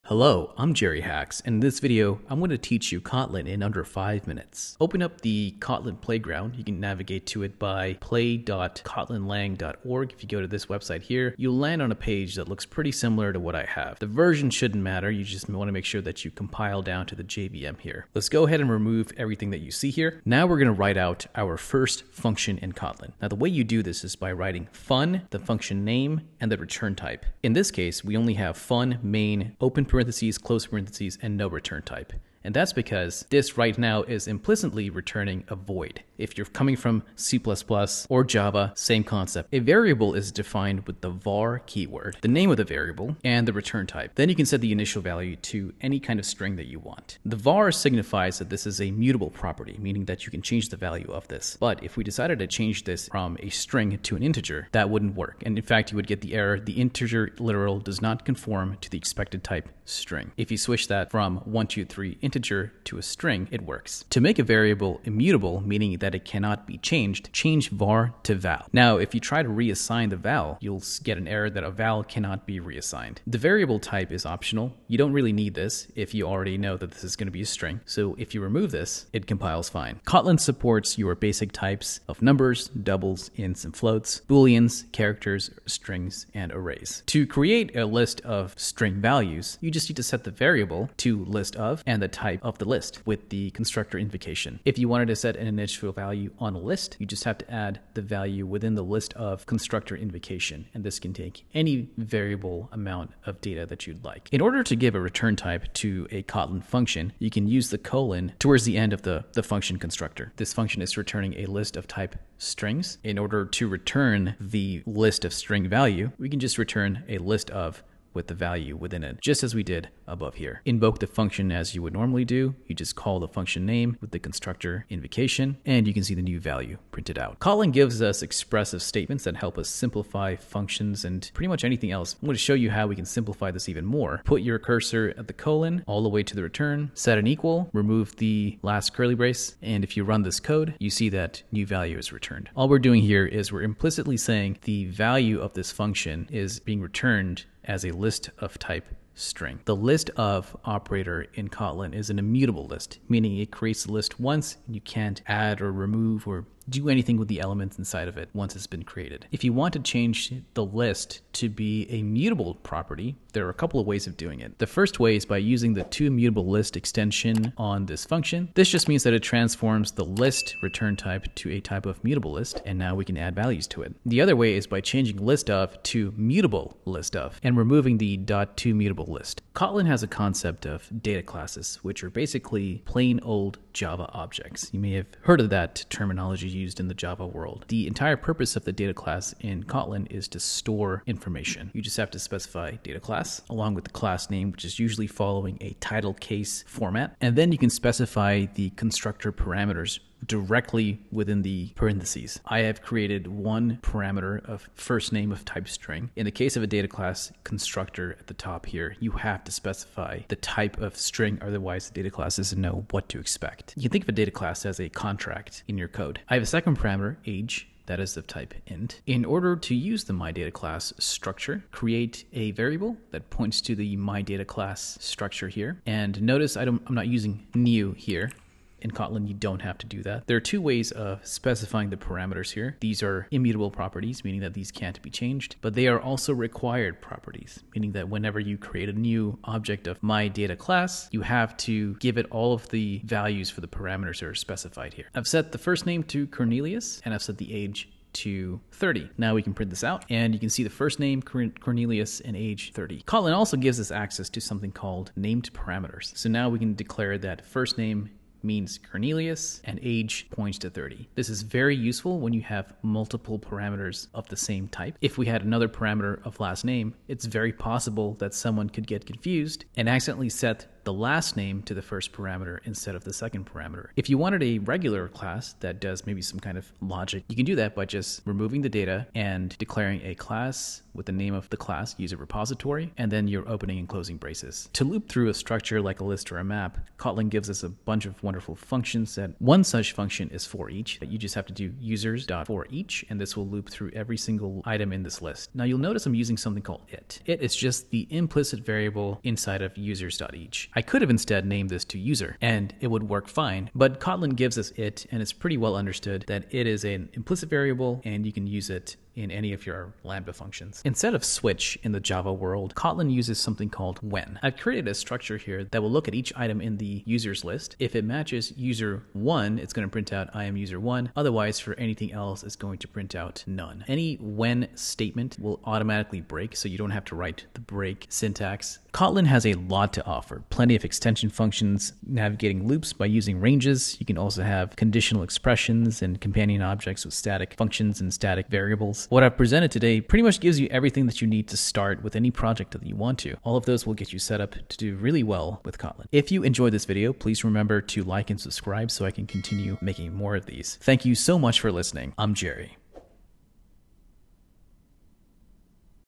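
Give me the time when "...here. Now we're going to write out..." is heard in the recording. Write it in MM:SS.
00:19.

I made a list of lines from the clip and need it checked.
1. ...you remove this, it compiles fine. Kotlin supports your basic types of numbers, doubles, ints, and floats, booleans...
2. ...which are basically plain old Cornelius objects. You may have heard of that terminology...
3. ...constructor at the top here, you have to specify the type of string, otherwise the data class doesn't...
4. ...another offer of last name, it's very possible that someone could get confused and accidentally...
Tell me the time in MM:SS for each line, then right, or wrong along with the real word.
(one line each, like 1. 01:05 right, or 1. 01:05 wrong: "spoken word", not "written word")
1. 01:18 right
2. 03:01 wrong: "Java", not "Cornelius"
3. 03:27 right
4. 04:25 wrong: "parameter", not "offer".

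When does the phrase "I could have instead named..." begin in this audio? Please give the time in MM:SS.
05:00.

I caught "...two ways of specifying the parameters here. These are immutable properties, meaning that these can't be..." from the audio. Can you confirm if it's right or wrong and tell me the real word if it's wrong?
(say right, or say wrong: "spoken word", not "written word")
right.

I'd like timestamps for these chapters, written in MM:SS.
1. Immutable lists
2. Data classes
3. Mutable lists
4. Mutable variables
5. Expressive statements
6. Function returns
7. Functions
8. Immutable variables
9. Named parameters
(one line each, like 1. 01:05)
1. 01:27
2. 03:00
3. 02:30
4. 00:40
5. 02:09
6. 01:44
7. 00:28
8. 01:04
9. 04:14.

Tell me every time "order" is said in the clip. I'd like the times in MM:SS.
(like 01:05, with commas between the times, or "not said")
01:44, 01:53, 03:39.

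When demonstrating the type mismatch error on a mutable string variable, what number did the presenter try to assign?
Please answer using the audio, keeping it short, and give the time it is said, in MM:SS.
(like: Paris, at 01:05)
123, at 01:01.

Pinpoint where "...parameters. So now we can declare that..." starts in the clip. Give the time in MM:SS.
04:15.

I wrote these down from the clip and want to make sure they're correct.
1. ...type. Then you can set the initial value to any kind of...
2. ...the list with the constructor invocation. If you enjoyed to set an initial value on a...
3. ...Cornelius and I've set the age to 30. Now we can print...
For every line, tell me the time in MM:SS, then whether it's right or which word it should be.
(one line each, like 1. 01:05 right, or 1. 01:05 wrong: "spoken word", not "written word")
1. 00:43 right
2. 01:32 wrong: "wanted", not "enjoyed"
3. 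04:06 right.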